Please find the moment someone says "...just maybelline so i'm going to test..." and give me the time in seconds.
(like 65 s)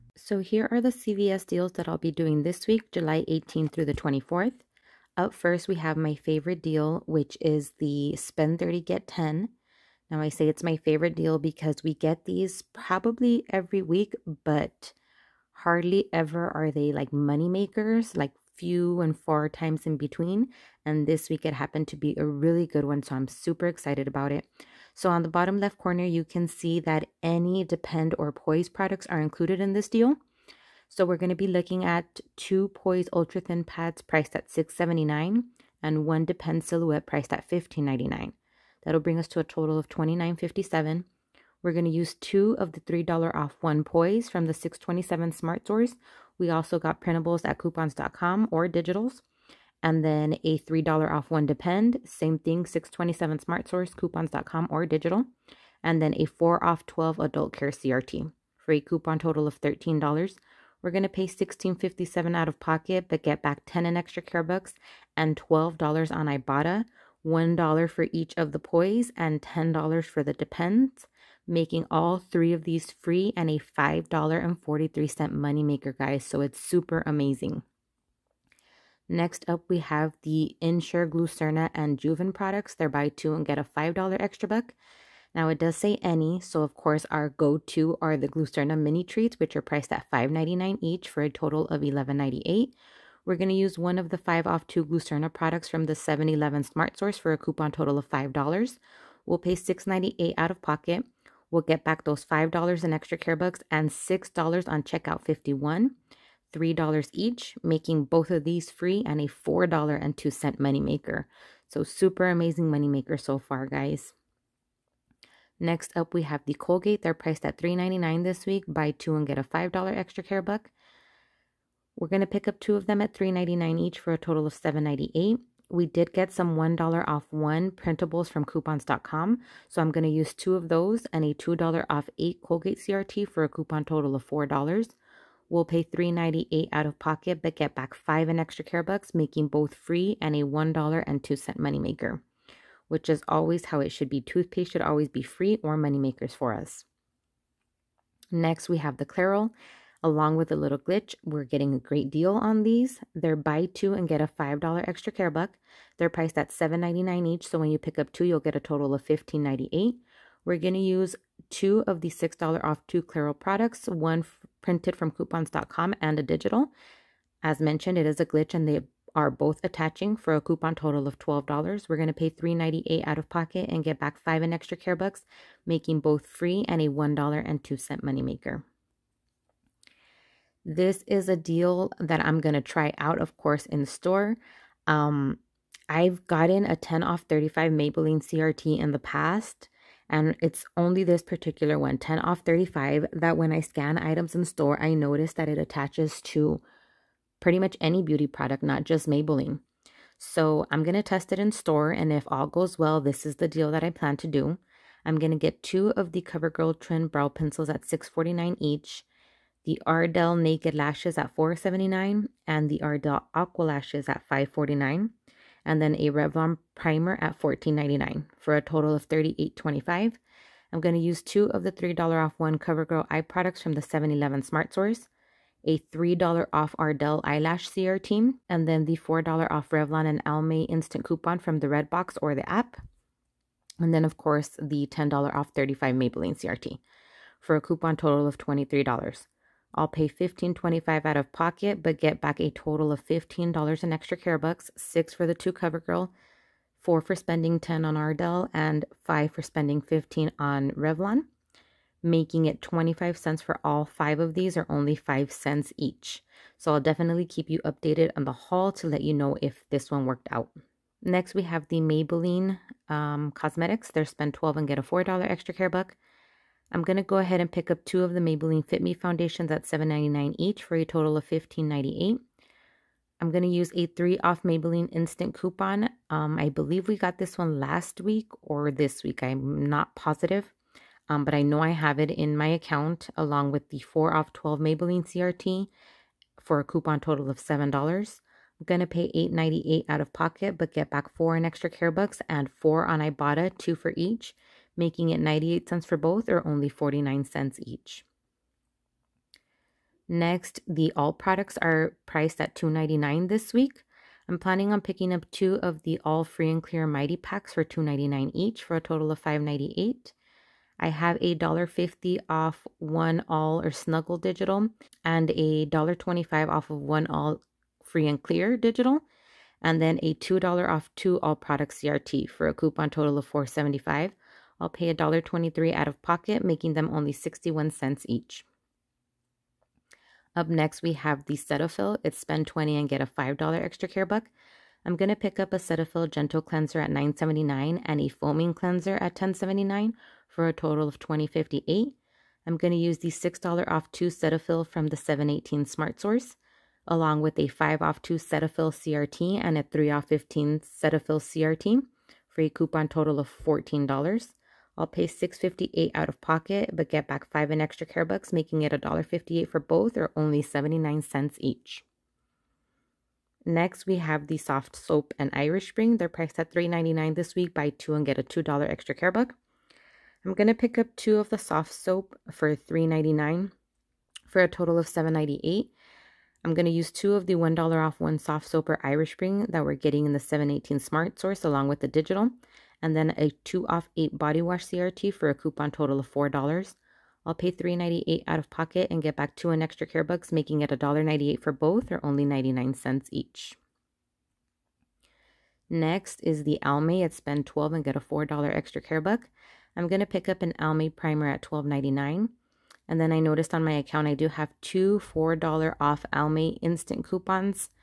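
198 s.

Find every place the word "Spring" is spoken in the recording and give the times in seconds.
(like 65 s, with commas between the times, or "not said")
365 s, 379 s.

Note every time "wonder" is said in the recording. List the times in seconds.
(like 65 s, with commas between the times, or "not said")
not said.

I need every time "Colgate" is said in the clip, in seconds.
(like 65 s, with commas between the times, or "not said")
116 s, 132 s.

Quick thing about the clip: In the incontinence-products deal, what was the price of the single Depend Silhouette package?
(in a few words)
$15.99.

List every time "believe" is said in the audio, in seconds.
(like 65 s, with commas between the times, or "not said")
276 s.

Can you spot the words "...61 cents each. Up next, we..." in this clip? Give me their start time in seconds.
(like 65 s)
327 s.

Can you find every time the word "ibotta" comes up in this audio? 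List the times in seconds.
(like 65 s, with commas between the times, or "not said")
66 s, 292 s.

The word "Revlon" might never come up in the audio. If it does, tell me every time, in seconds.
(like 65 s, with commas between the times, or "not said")
216 s, 229 s, 250 s.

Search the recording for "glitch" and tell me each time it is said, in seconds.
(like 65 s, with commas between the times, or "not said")
150 s, 168 s.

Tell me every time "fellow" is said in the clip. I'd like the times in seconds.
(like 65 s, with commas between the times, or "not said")
not said.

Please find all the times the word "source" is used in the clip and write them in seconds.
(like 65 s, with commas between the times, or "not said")
45 s, 53 s, 96 s, 224 s, 345 s, 381 s.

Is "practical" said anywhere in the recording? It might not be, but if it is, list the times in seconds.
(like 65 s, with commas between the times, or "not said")
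not said.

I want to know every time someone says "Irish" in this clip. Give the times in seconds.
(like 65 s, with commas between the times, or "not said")
365 s, 378 s.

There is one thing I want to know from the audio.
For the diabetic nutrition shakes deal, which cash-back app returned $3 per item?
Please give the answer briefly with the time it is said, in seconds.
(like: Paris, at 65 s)
Checkout 51, at 104 s.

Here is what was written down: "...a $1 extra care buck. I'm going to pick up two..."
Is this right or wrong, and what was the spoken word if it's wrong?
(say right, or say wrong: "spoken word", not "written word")
wrong: "2", not "1".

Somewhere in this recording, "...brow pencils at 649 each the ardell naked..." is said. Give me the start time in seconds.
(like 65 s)
207 s.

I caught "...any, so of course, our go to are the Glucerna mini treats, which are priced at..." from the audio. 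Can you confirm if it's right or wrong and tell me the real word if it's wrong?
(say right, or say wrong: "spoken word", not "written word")
right.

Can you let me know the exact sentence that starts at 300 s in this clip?
Next, the all products are priced at two ninety nine this week.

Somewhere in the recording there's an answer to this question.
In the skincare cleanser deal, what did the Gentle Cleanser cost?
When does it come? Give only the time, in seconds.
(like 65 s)
336 s.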